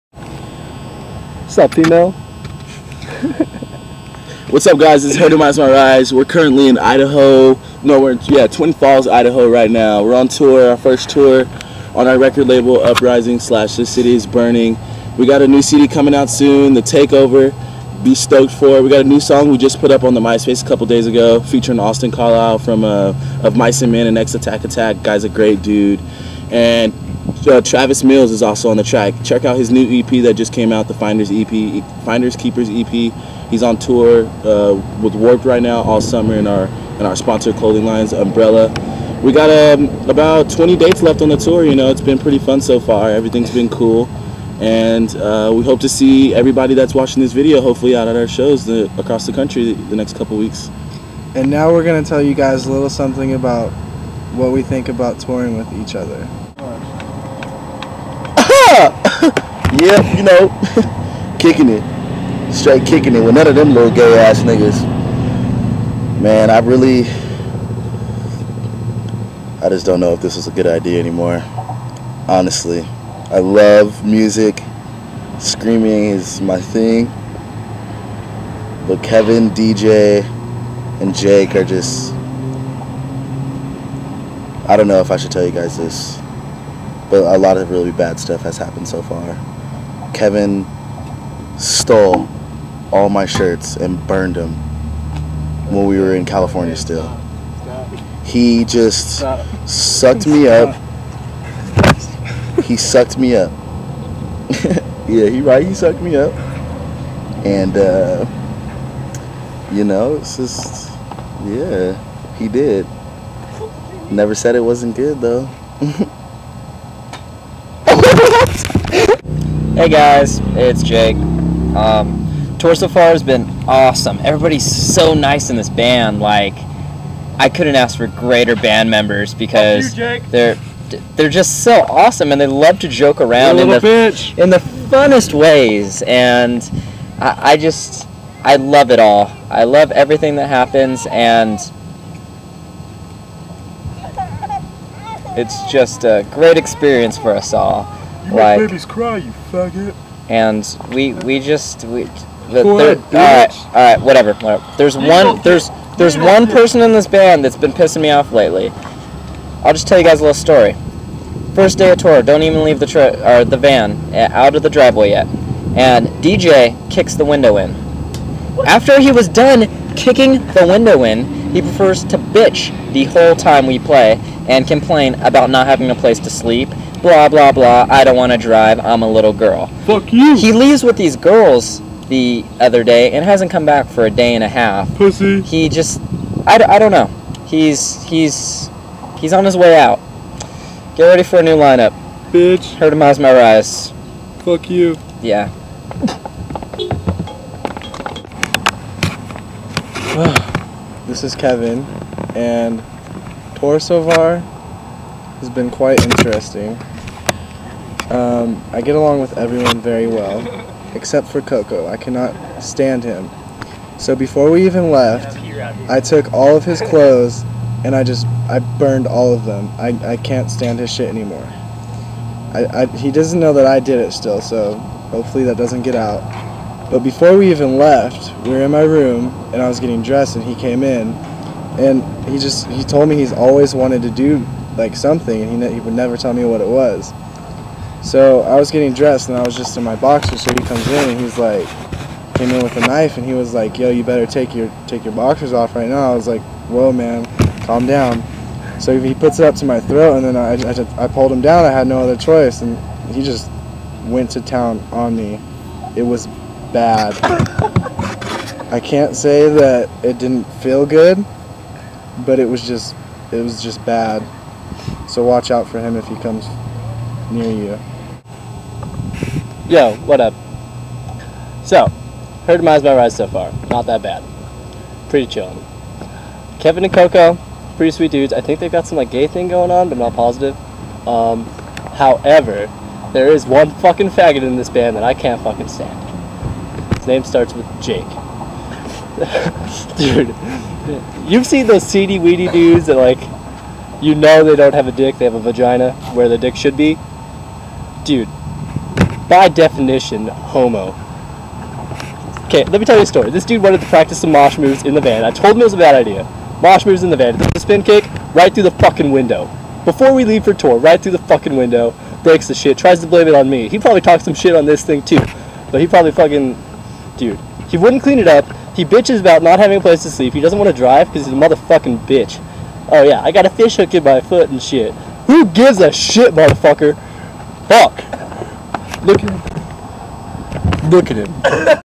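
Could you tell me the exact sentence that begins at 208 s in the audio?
Um, I get along with everyone very well, except for Coco.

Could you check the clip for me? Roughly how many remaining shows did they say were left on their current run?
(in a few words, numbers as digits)
20.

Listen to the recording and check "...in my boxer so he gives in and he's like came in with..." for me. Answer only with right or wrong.
wrong.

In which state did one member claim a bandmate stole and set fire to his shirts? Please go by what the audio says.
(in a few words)
California.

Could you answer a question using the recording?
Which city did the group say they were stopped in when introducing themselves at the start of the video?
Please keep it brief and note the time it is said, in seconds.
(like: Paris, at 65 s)
Twin Falls, at 8 s.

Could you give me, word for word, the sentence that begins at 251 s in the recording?
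I had no other choice and he just went to town on me.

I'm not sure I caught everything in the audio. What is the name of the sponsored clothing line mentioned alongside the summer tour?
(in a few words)
Umbrella.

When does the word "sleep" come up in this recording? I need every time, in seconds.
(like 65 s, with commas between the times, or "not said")
176 s, 320 s.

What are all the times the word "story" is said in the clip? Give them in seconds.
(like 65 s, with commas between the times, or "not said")
160 s, 303 s.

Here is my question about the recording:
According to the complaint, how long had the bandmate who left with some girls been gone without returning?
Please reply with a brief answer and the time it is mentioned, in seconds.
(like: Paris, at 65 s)
a day and a half, at 184 s.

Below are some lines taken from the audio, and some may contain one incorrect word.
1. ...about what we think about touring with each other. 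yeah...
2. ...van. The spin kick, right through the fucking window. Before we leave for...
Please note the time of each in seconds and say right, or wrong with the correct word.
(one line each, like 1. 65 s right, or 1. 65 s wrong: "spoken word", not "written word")
1. 53 s right
2. 307 s right.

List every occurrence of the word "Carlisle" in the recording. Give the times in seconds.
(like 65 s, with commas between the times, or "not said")
22 s.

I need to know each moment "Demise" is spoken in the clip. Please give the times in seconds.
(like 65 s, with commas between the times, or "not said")
5 s, 192 s, 272 s.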